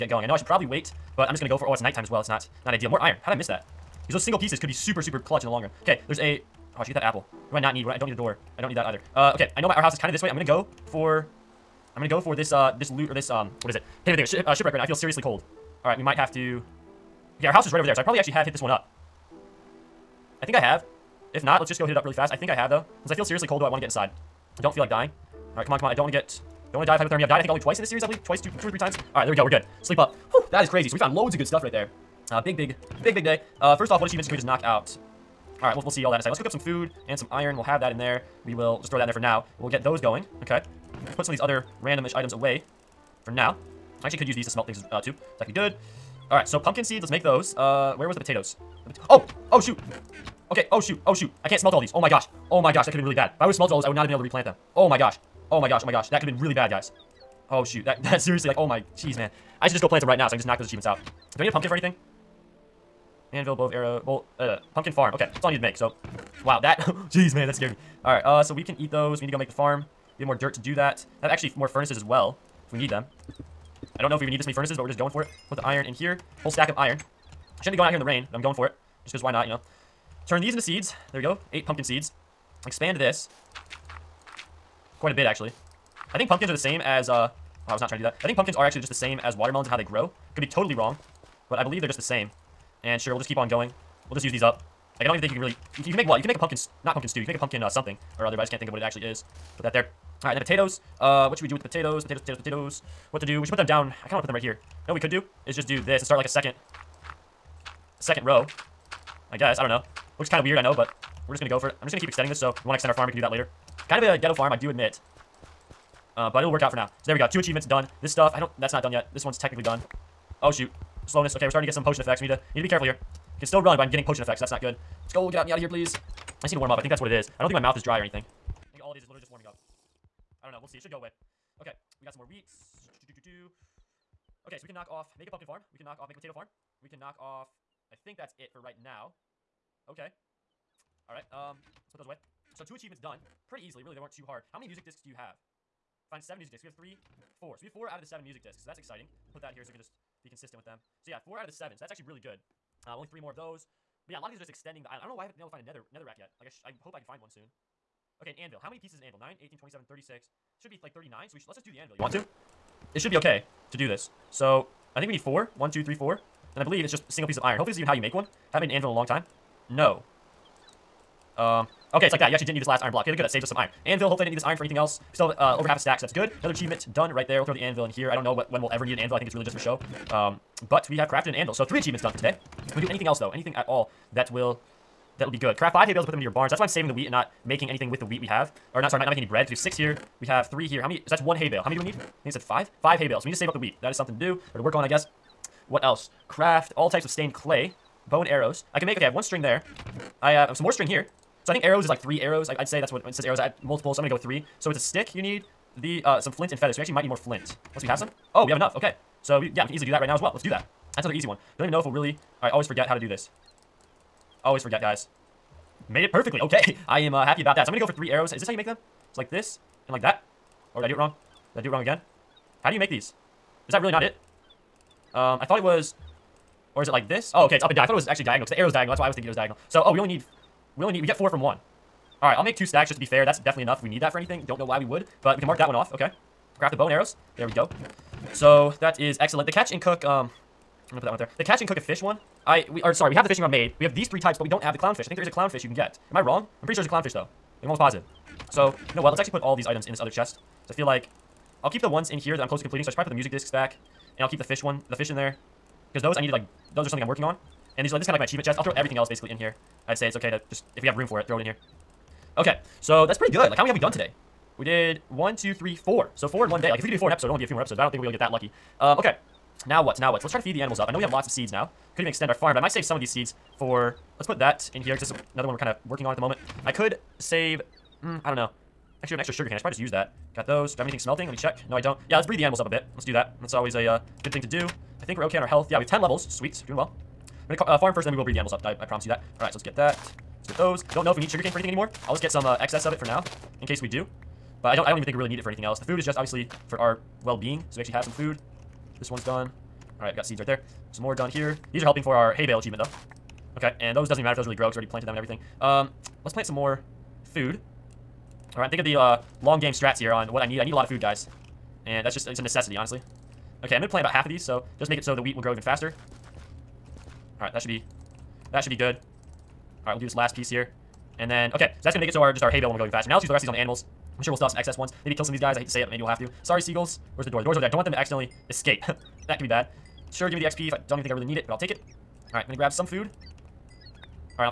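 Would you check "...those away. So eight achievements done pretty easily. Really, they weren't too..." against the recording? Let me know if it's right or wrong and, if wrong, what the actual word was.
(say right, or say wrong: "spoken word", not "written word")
wrong: "two", not "eight".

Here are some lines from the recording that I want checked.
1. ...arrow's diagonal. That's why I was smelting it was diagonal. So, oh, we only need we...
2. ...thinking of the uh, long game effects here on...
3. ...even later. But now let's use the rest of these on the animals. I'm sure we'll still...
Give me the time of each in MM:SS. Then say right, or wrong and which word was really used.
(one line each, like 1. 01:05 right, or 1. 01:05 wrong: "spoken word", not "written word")
1. 03:48 wrong: "thinking", not "smelting"
2. 05:08 wrong: "strats", not "effects"
3. 05:22 wrong: "faster", not "later".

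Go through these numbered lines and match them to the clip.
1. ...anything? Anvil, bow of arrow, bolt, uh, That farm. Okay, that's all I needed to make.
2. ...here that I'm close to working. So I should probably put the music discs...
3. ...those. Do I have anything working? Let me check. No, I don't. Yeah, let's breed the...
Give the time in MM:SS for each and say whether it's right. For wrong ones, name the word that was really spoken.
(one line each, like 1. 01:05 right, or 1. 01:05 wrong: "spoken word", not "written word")
1. 01:01 wrong: "Pumpkin", not "That"
2. 04:12 wrong: "completing", not "working"
3. 04:40 wrong: "smelting", not "working".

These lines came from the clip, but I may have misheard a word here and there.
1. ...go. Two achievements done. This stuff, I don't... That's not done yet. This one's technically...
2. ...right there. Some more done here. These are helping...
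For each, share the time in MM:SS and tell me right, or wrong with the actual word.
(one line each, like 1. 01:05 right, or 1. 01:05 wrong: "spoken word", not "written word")
1. 01:57 right
2. 05:00 right.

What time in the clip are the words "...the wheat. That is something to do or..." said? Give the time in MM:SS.
03:13.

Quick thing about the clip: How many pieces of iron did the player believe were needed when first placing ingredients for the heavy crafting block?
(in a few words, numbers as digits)
4.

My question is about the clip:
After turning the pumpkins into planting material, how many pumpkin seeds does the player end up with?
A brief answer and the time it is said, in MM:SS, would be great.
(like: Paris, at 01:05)
8, at 01:21.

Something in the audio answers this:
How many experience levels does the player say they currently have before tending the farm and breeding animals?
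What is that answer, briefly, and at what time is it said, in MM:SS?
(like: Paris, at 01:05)
10, at 04:45.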